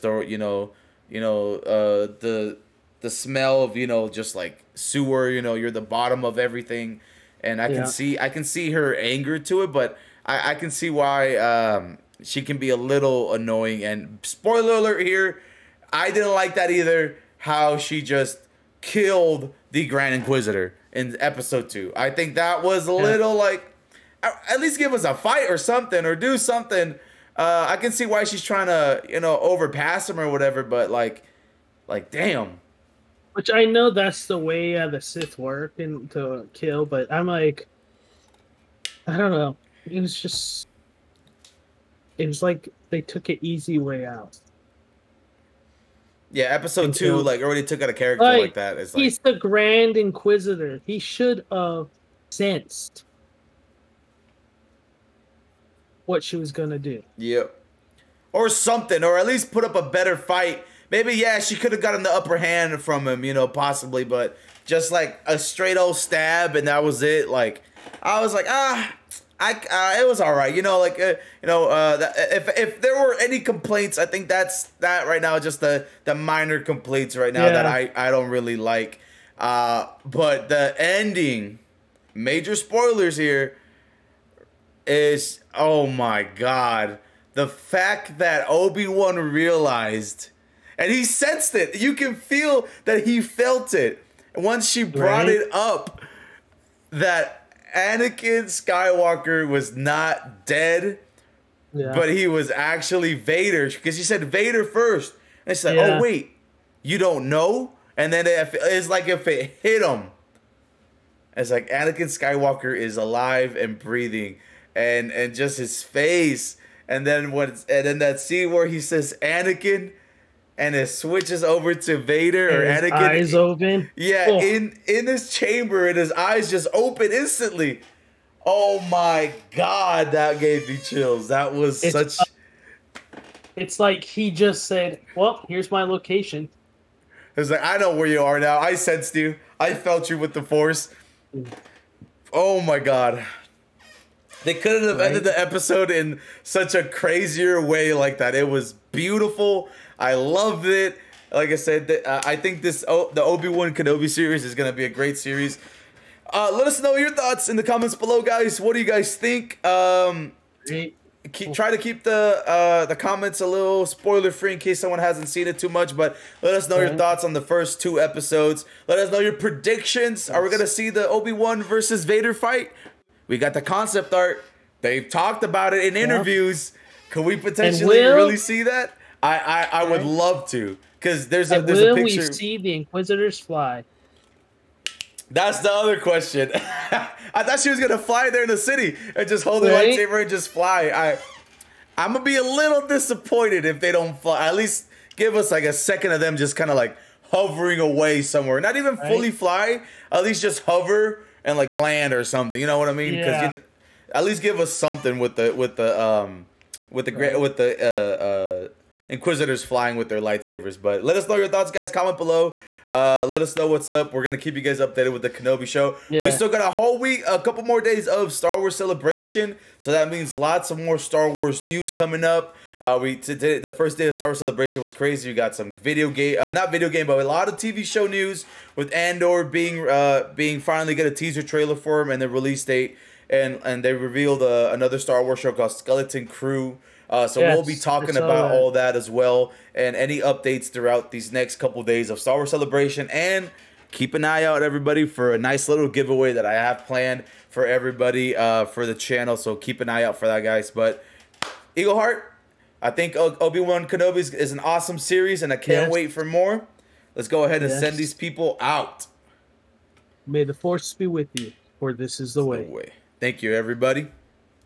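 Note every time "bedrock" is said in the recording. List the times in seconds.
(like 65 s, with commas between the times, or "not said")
not said.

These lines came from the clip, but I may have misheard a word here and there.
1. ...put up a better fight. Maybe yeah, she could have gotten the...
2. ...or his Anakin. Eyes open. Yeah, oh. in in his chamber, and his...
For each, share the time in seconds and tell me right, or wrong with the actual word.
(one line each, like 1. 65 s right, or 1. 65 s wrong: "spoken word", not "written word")
1. 59 s right
2. 122 s right.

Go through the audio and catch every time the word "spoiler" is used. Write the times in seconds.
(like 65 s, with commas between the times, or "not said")
14 s, 82 s, 163 s.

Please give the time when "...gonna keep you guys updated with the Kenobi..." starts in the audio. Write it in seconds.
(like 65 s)
214 s.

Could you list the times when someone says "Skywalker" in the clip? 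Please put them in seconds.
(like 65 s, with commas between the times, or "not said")
98 s, 112 s.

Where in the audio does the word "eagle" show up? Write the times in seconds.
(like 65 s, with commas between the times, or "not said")
251 s.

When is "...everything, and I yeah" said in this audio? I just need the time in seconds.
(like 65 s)
6 s.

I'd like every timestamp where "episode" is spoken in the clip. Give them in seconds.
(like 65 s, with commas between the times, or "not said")
21 s, 46 s, 145 s, 167 s.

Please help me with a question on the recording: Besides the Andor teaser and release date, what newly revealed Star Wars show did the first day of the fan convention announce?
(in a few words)
Skeleton Crew.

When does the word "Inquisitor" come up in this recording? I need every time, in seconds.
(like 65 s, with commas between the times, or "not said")
20 s, 49 s, 182 s, 209 s.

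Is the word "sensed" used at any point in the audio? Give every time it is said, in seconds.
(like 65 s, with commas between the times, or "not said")
52 s, 91 s, 138 s.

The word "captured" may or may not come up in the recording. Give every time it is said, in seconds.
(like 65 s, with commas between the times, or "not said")
not said.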